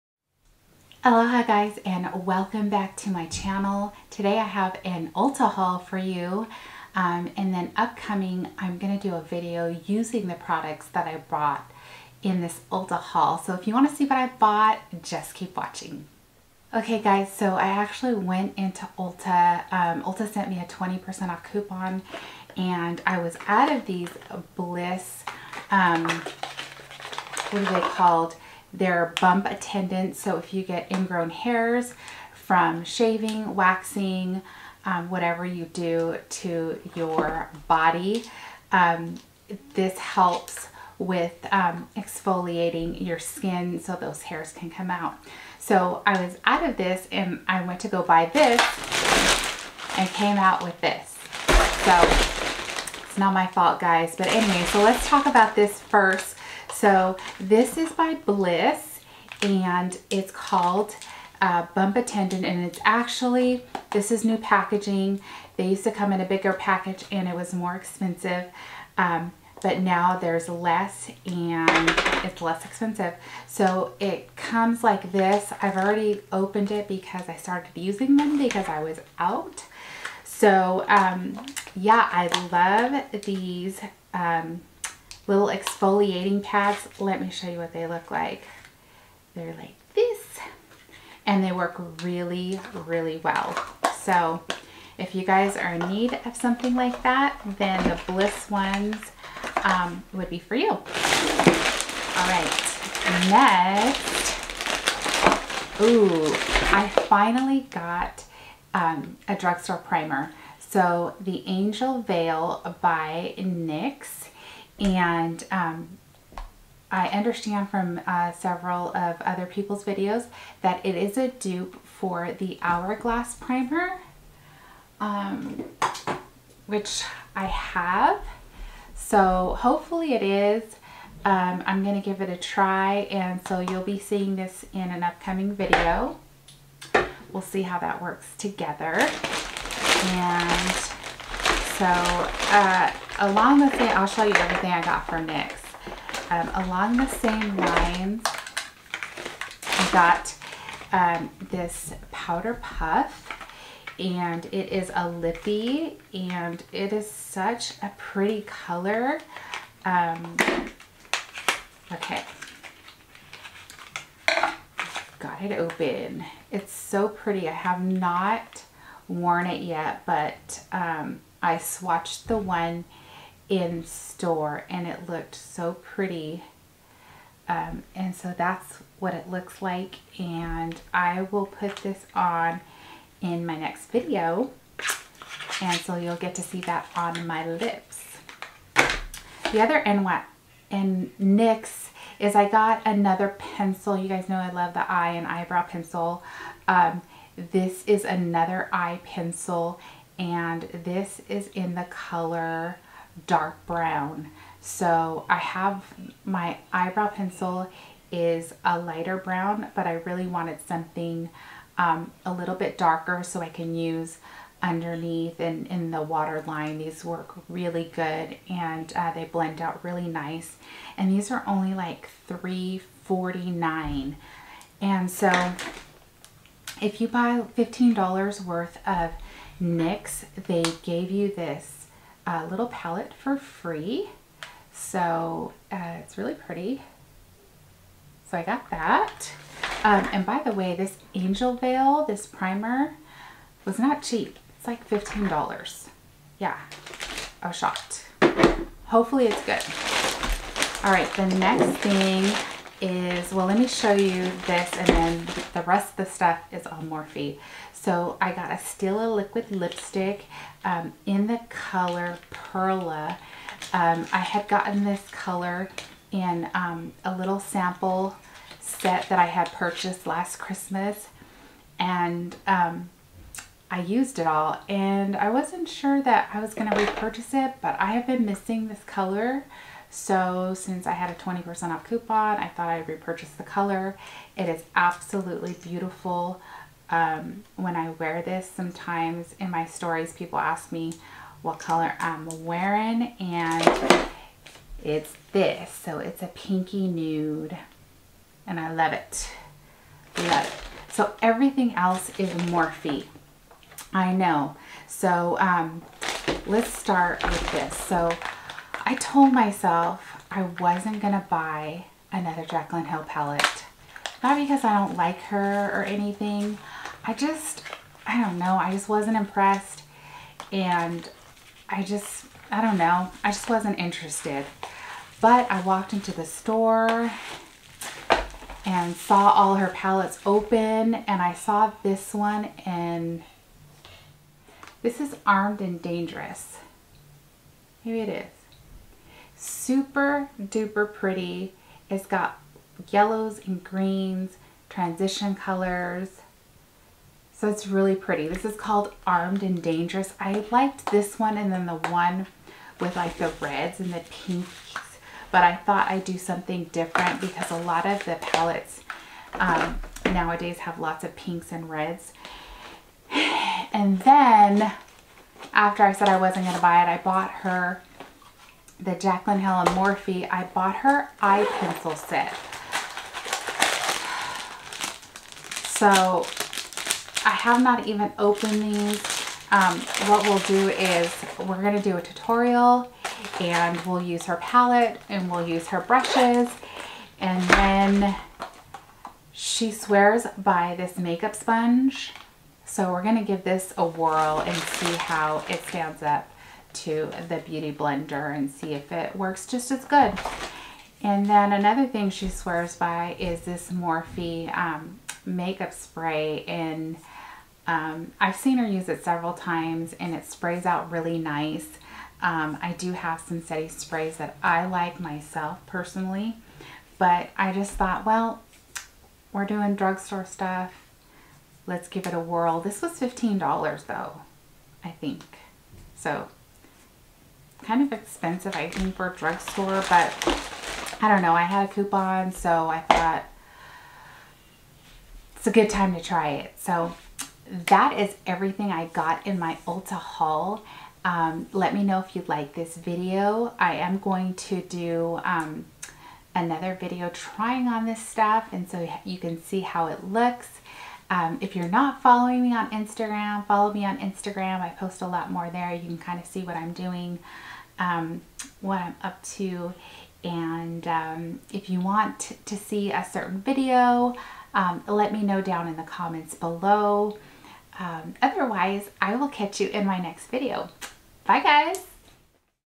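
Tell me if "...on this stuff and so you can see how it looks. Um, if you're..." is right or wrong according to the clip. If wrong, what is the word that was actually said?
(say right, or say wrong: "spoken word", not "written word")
right.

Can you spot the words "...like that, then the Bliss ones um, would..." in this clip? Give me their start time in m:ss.
1:36.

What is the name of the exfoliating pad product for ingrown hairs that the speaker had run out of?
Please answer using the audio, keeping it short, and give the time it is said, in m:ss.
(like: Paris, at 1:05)
Bump Attendant, at 1:01.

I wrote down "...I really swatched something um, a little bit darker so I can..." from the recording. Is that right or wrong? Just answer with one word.
wrong.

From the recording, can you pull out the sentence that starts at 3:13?
You guys know I love the eye and eyebrow pencil.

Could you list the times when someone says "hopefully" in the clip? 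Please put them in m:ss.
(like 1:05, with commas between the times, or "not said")
2:09, 4:08.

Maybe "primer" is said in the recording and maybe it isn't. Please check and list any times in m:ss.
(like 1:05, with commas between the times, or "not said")
1:49, 2:03, 4:02.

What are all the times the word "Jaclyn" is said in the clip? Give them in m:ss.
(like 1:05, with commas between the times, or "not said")
5:12, 6:08.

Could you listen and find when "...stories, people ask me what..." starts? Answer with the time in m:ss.
4:49.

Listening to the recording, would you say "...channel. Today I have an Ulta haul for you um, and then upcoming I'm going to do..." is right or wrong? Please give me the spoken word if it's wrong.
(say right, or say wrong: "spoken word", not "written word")
right.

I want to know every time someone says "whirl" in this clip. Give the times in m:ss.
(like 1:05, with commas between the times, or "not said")
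6:33, 7:02.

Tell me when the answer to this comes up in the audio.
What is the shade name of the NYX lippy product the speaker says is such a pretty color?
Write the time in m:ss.
2:32.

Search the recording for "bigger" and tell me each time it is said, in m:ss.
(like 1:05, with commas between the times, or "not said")
1:06.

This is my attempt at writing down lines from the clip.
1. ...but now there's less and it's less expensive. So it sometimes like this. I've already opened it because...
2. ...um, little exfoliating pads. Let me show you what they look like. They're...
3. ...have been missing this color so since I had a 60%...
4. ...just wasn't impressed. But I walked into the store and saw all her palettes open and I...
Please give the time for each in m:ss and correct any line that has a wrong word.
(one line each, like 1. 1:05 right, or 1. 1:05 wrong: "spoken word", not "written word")
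1. 1:09 wrong: "comes", not "sometimes"
2. 1:24 right
3. 4:37 wrong: "20", not "60"
4. 5:23 wrong: "interested", not "impressed".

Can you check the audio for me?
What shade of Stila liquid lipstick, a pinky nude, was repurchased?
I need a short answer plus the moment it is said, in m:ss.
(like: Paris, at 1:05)
Perla, at 4:22.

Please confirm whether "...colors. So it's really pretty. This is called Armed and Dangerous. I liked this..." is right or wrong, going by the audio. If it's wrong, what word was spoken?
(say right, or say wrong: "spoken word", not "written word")
right.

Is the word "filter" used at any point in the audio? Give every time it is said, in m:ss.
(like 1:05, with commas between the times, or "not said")
not said.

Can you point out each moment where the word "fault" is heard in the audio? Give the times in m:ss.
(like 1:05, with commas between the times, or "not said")
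0:53.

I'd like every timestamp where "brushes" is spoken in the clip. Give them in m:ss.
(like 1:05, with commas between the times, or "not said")
6:25.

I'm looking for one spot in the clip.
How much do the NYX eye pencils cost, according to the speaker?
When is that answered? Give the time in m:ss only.
3:42.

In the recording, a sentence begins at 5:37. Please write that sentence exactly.
Maybe it is super duper pretty.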